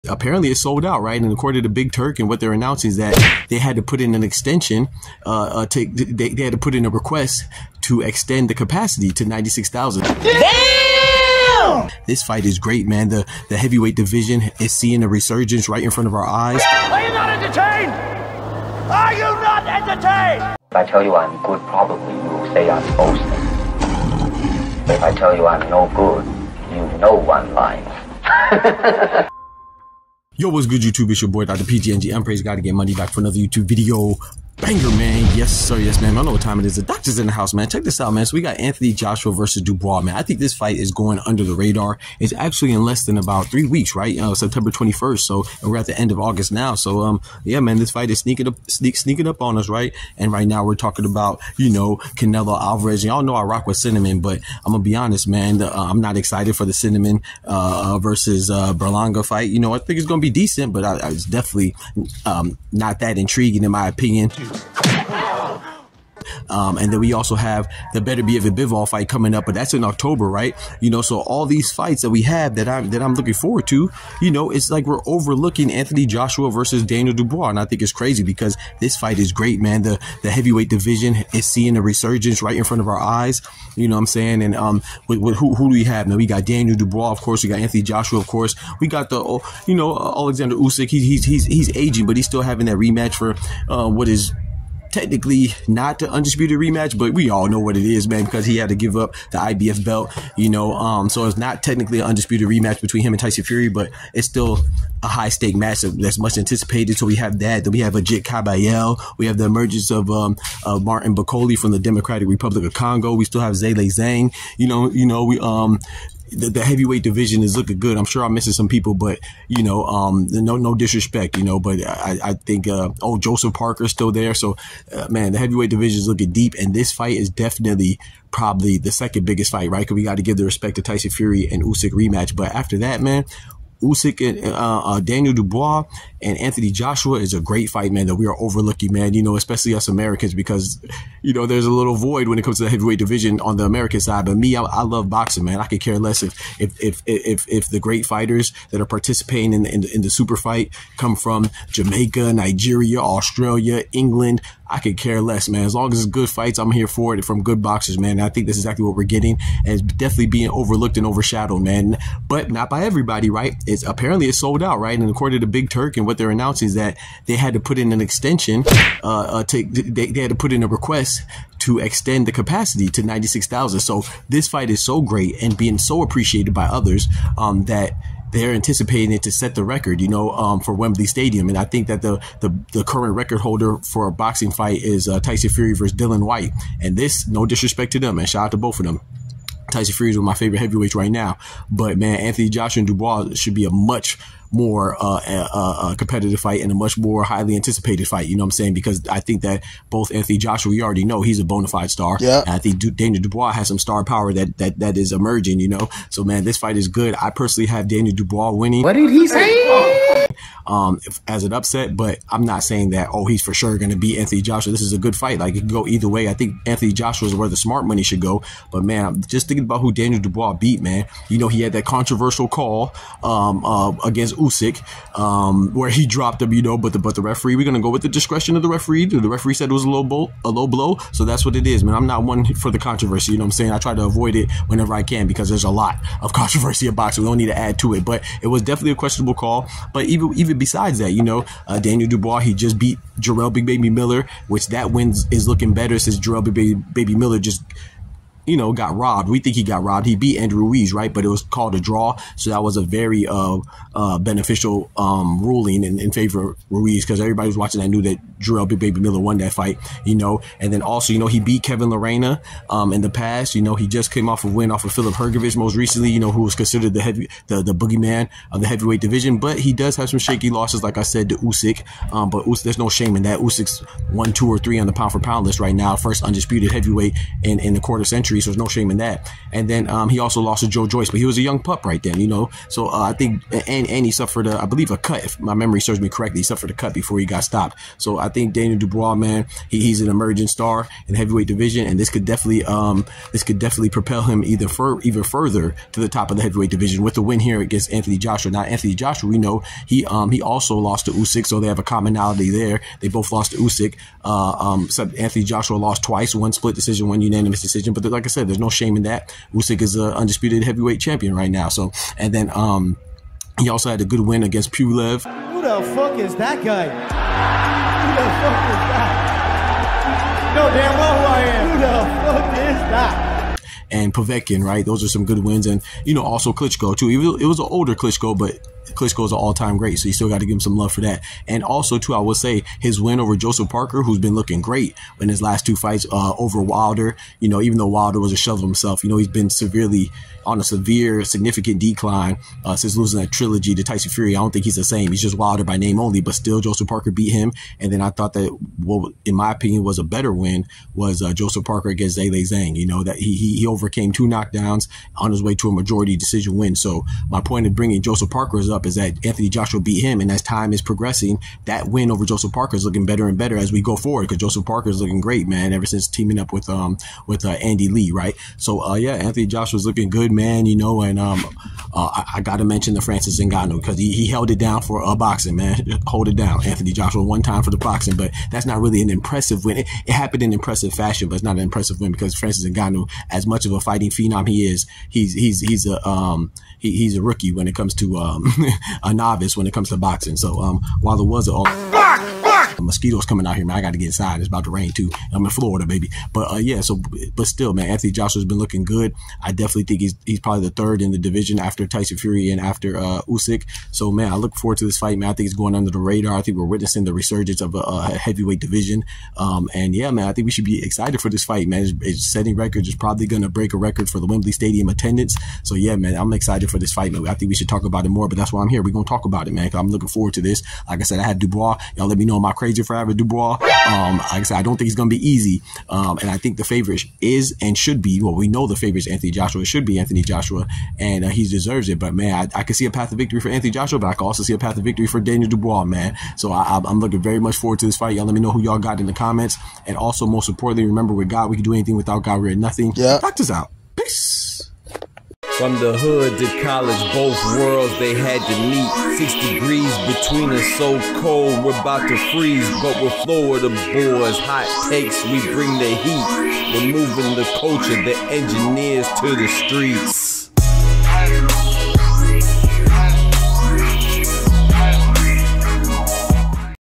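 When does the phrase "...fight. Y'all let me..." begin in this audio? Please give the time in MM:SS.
07:17.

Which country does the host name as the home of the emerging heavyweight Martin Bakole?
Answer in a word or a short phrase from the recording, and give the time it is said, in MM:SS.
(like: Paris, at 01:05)
Democratic Republic of Congo, at 01:51.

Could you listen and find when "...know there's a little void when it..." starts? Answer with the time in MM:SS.
02:21.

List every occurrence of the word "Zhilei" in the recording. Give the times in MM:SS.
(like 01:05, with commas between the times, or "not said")
01:53, 05:52.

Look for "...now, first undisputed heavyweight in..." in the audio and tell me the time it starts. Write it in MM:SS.
04:35.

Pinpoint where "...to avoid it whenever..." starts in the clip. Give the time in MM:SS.
03:53.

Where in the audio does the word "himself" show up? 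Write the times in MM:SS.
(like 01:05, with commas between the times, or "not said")
05:38.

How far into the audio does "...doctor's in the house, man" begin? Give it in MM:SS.
00:36.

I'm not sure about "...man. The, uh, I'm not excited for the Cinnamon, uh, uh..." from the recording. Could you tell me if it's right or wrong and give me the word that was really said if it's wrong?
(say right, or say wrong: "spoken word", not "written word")
right.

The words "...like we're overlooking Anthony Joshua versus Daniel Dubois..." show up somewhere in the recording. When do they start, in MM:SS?
01:14.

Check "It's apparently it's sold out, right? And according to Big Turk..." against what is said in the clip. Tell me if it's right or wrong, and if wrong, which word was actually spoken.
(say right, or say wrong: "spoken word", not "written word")
right.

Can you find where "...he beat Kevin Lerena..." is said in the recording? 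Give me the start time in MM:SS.
04:21.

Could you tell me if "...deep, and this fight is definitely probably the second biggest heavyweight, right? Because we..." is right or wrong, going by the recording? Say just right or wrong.
wrong.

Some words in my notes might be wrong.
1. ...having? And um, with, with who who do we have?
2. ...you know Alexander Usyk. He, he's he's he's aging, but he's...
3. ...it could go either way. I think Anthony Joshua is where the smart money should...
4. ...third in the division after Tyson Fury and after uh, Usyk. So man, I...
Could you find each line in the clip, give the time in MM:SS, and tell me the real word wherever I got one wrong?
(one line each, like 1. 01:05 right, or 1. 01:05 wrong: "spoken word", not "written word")
1. 01:24 wrong: "saying", not "having"
2. 01:29 right
3. 03:35 right
4. 06:40 right.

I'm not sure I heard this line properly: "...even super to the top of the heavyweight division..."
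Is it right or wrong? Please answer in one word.
wrong.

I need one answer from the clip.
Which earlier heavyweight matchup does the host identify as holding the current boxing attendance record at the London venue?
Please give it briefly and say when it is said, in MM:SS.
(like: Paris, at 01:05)
Tyson Fury versus Dillian Whyte, at 03:05.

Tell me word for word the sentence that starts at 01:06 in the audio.
Um, and then we also have the Beterbiev a Bivol fight coming up, but that's in October, right?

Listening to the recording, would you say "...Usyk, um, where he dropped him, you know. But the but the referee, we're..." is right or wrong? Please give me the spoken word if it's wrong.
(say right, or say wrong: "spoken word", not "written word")
right.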